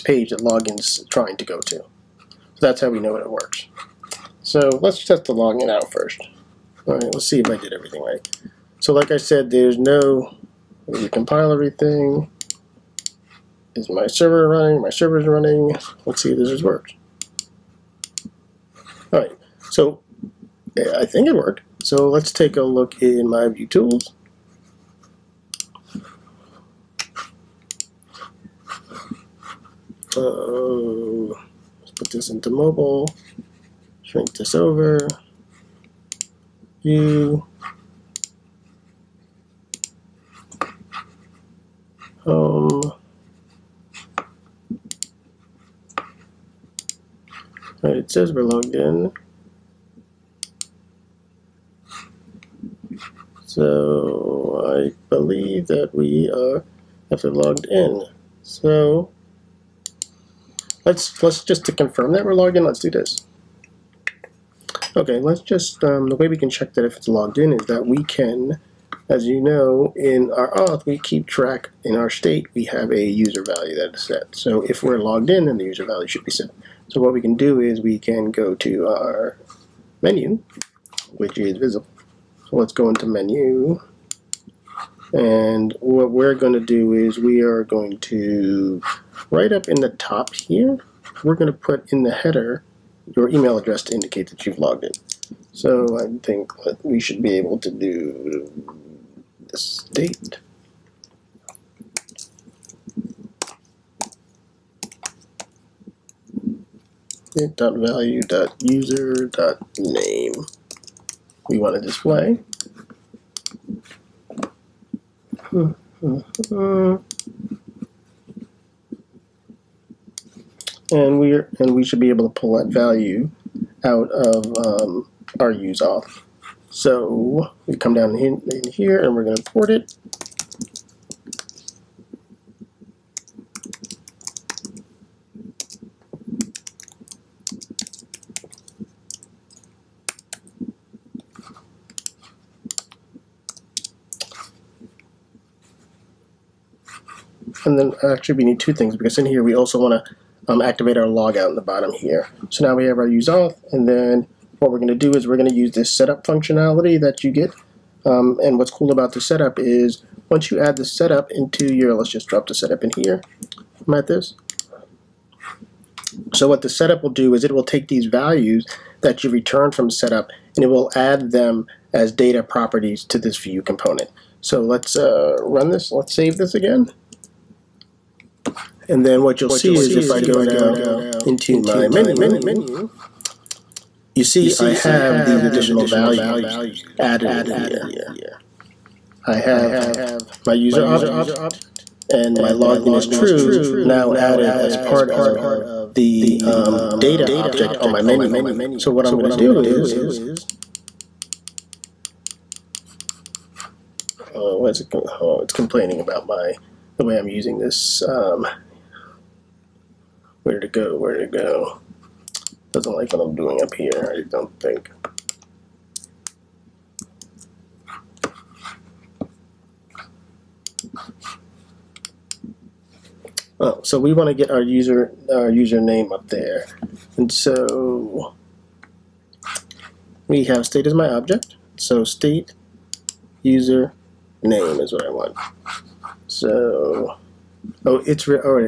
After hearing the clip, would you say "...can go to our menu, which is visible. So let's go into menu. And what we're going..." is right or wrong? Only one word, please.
right.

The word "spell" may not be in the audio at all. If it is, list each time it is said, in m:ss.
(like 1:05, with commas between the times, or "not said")
not said.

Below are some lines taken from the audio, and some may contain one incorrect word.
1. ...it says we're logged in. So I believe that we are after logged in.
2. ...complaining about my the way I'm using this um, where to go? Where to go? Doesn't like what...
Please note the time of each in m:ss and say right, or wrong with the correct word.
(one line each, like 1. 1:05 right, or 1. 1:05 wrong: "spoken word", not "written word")
1. 0:47 right
2. 3:25 right.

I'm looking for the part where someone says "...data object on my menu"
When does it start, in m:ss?
3:16.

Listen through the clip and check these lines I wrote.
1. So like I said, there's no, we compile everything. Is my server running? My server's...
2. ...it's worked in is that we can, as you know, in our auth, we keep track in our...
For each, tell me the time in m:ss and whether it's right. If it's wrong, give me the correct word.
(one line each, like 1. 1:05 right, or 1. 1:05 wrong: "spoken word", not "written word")
1. 0:08 right
2. 1:06 wrong: "logged", not "worked".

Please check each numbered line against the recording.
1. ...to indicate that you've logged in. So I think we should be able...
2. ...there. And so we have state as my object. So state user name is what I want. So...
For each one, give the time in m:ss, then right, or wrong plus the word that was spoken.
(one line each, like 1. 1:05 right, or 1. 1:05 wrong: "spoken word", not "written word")
1. 1:33 right
2. 3:46 right.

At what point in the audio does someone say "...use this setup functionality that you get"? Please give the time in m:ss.
2:35.